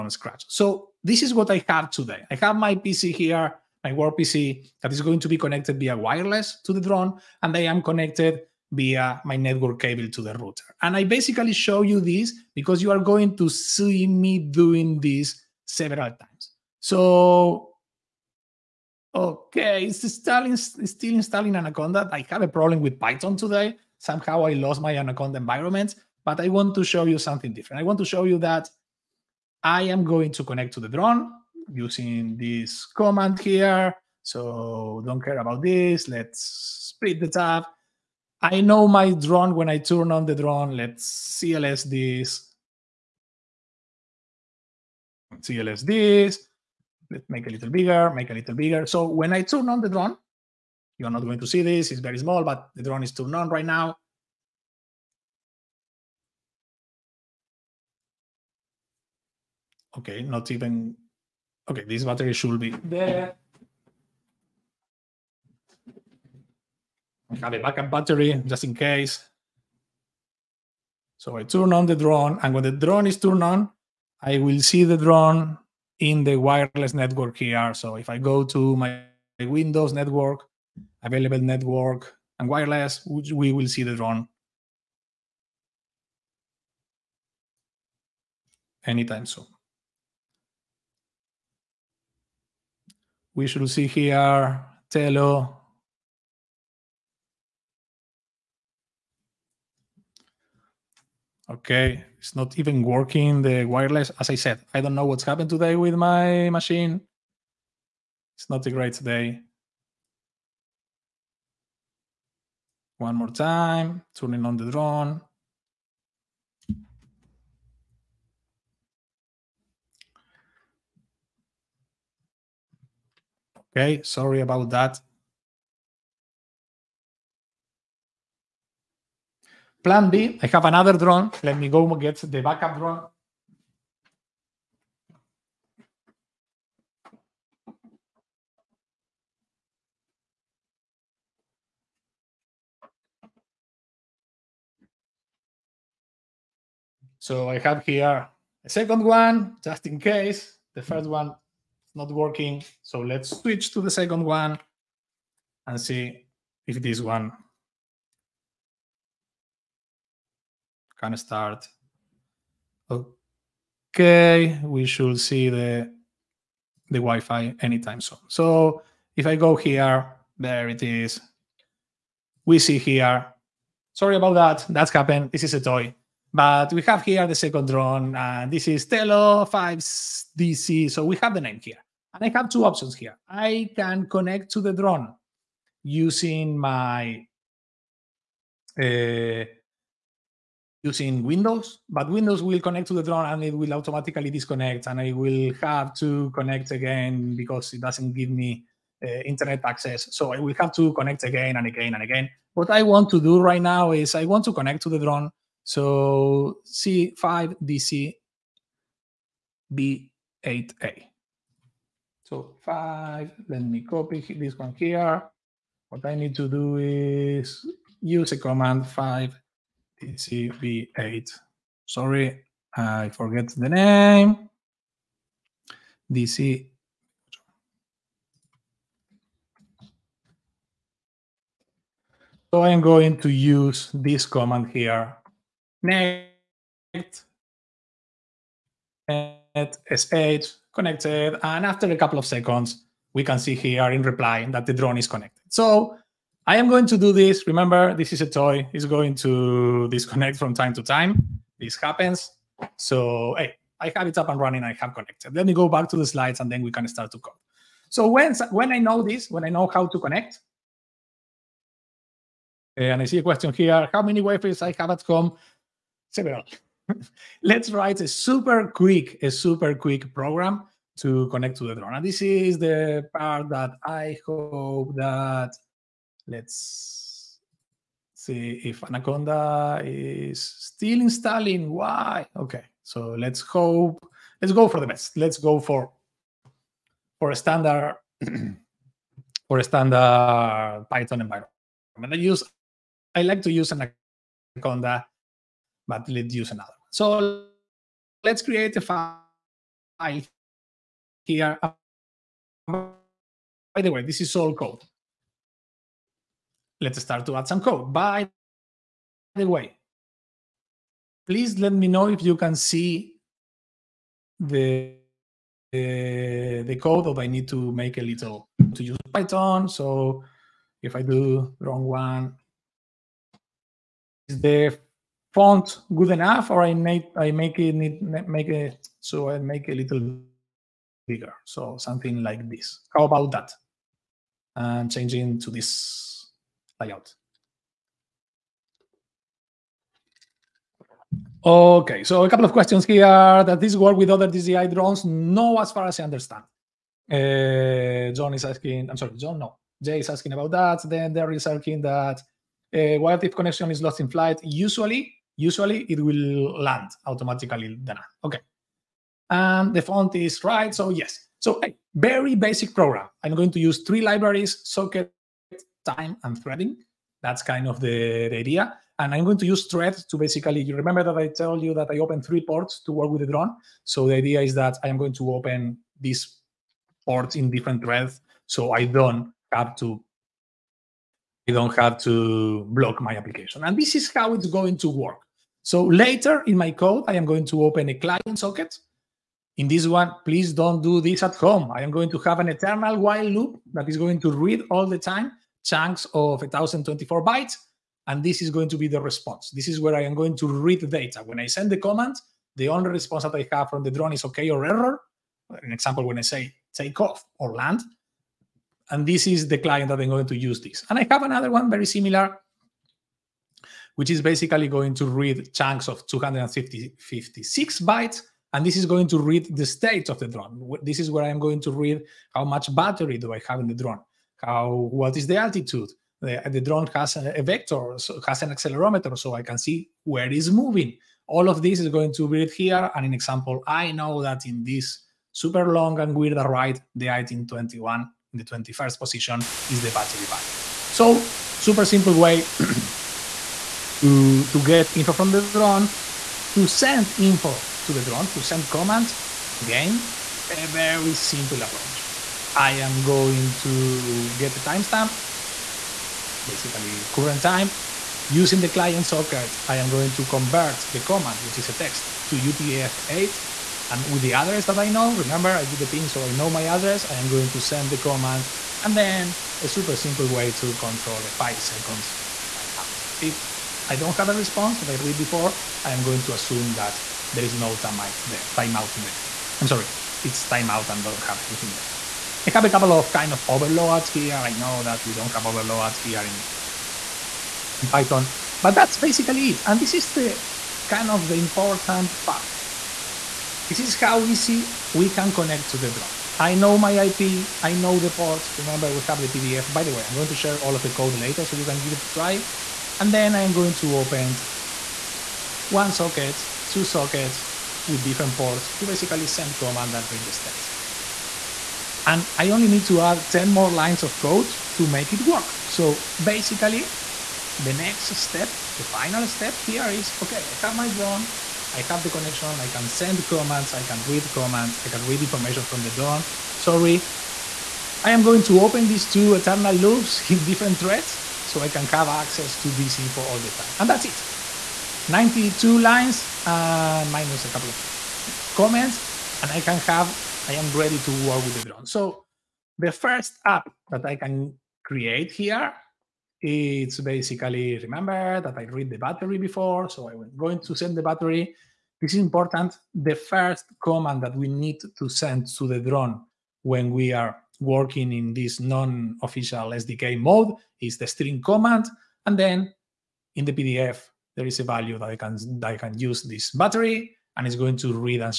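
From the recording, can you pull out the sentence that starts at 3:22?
What I want to do right now is I want to connect to the drone.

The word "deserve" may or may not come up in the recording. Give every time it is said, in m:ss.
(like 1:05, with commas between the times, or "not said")
not said.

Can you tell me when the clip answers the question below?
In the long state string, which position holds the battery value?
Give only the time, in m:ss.
7:18.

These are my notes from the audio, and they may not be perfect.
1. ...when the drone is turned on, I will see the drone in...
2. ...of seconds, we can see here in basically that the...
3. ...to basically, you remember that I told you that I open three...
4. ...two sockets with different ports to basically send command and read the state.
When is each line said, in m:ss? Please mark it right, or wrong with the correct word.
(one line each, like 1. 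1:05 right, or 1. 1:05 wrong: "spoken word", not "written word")
1. 1:12 right
2. 4:02 wrong: "reply", not "basically"
3. 6:10 right
4. 8:26 right.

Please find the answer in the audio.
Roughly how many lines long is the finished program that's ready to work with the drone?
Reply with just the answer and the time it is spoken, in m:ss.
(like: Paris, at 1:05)
92, at 8:55.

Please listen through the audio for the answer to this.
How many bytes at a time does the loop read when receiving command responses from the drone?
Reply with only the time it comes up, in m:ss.
6:36.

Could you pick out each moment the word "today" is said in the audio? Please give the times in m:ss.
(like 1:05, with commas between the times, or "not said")
0:01, 0:23, 1:45.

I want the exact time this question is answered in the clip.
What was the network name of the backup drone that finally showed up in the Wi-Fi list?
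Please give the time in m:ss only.
2:58.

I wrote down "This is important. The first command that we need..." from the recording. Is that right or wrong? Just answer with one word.
right.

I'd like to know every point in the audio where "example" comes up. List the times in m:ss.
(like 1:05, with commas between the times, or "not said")
6:45, 7:13.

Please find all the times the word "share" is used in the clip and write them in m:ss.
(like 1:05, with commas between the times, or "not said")
8:20.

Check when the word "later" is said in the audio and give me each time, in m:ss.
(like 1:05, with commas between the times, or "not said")
6:25, 8:21.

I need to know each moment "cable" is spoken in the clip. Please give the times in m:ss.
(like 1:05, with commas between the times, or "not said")
0:09.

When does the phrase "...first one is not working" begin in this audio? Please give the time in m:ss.
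2:30.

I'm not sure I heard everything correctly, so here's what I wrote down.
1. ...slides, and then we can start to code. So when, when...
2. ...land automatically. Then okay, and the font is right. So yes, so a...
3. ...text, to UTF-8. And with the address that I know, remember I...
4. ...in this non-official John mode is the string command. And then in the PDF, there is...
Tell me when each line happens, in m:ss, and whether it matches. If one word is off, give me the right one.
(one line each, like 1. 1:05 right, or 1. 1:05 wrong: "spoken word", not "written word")
1. 4:16 right
2. 5:56 right
3. 7:41 right
4. 9:18 wrong: "SDK", not "John".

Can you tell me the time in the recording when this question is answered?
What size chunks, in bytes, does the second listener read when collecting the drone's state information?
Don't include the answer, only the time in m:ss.
6:56.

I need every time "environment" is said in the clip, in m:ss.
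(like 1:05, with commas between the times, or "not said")
0:25, 4:51.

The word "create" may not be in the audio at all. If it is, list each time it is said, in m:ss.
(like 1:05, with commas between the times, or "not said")
4:58, 9:04.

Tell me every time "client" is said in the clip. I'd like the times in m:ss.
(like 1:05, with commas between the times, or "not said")
6:27, 6:49, 7:38.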